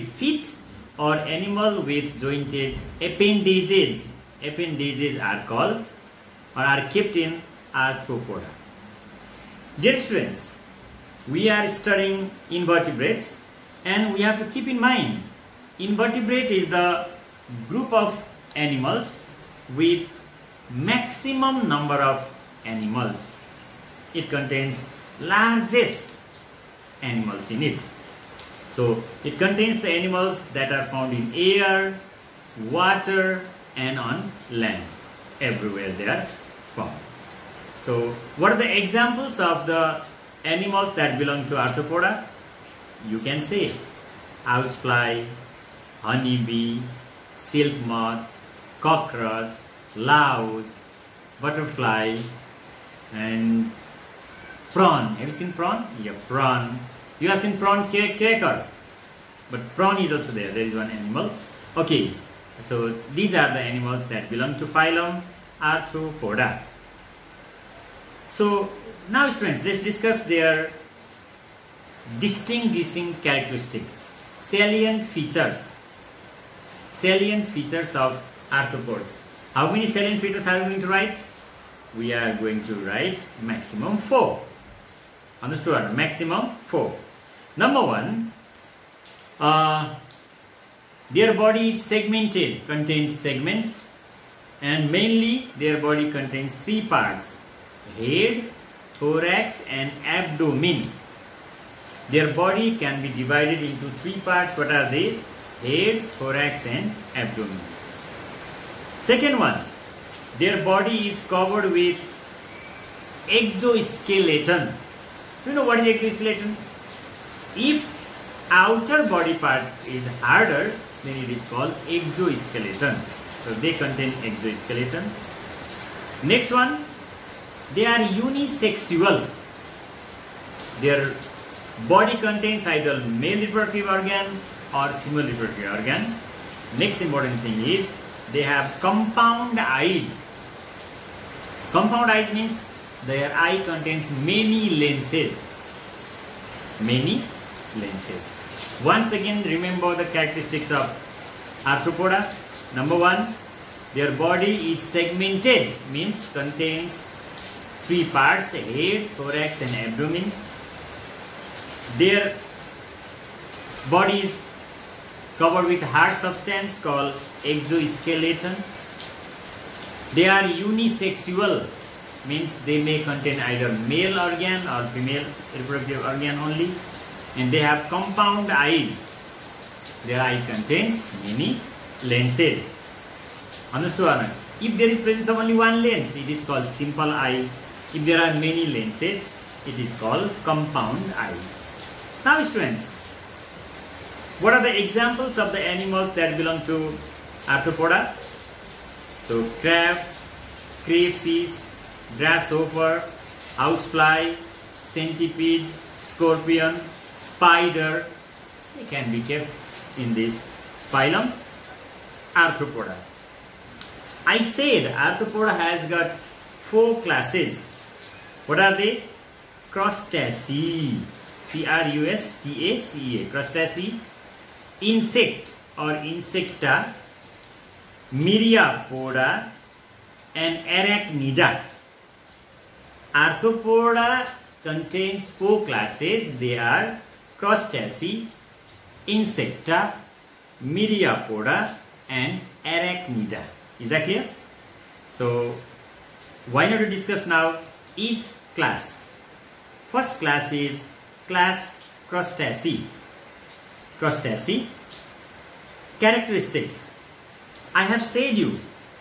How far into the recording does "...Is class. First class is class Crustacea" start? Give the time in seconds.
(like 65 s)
247 s.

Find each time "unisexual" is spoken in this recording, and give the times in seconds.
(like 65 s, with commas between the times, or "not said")
128 s, 170 s.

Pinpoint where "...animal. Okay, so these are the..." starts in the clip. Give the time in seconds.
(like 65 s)
60 s.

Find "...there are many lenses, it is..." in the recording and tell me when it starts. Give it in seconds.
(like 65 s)
188 s.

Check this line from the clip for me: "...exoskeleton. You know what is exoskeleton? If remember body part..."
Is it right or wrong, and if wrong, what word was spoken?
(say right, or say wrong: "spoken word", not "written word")
wrong: "outer", not "remember".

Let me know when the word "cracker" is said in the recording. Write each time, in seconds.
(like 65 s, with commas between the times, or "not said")
57 s.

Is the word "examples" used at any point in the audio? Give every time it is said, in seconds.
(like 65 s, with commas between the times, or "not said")
38 s, 194 s.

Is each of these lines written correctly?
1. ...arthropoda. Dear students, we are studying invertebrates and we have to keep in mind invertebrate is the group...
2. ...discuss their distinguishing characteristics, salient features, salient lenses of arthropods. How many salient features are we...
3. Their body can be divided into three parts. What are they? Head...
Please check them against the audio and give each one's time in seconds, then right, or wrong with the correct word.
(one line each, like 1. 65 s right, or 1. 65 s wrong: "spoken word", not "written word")
1. 7 s right
2. 69 s wrong: "features", not "lenses"
3. 102 s right.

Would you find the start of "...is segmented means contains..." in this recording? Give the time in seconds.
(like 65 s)
154 s.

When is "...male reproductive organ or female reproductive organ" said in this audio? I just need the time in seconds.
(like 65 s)
133 s.